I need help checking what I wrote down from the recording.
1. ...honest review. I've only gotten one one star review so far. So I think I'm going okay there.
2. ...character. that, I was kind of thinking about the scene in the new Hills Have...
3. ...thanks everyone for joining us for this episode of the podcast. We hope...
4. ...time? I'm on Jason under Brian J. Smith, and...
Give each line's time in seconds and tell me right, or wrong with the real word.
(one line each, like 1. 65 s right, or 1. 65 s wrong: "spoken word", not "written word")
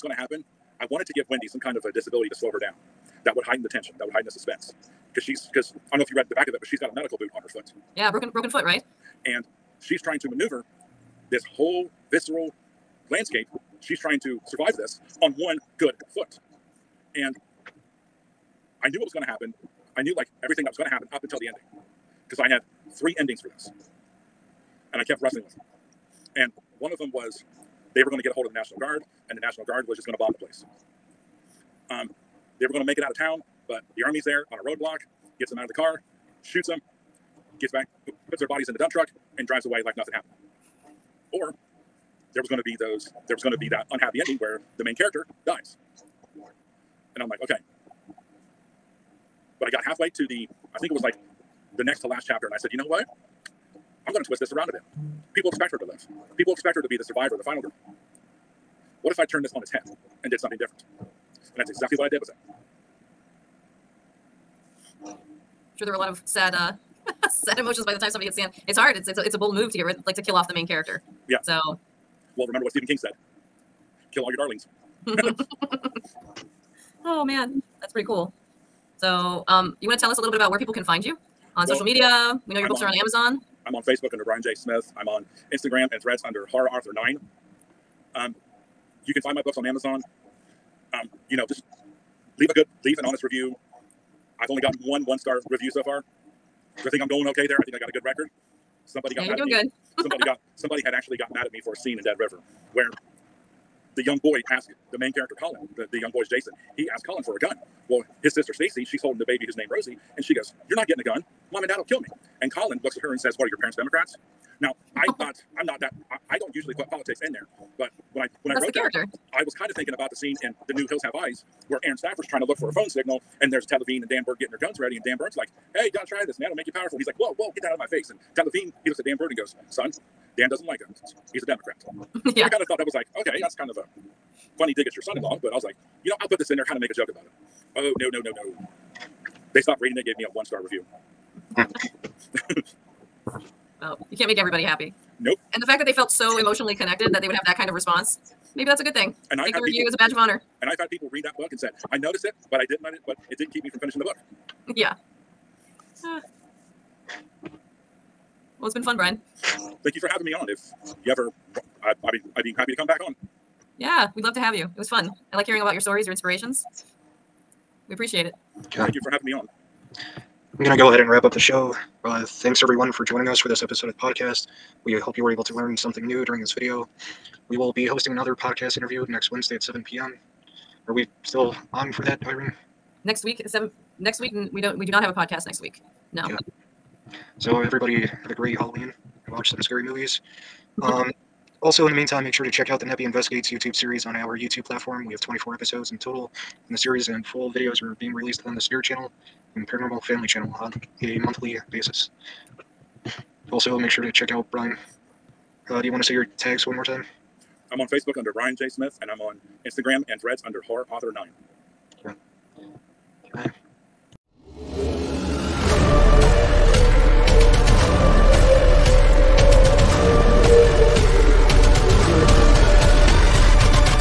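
1. 93 s right
2. 118 s right
3. 172 s right
4. 206 s wrong: "Facebook", not "Jason".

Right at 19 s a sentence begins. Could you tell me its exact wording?
I knew like everything that was going to happen up until the ending because I had three endings for this.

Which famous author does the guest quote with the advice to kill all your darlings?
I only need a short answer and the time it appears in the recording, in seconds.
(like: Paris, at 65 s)
Stephen King, at 72 s.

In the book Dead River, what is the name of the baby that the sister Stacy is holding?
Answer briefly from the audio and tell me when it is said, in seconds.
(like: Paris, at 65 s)
Rosie, at 109 s.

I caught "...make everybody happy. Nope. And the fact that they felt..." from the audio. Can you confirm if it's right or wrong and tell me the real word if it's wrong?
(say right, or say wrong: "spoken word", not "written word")
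right.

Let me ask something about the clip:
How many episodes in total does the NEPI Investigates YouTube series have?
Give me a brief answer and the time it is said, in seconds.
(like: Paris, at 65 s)
24, at 195 s.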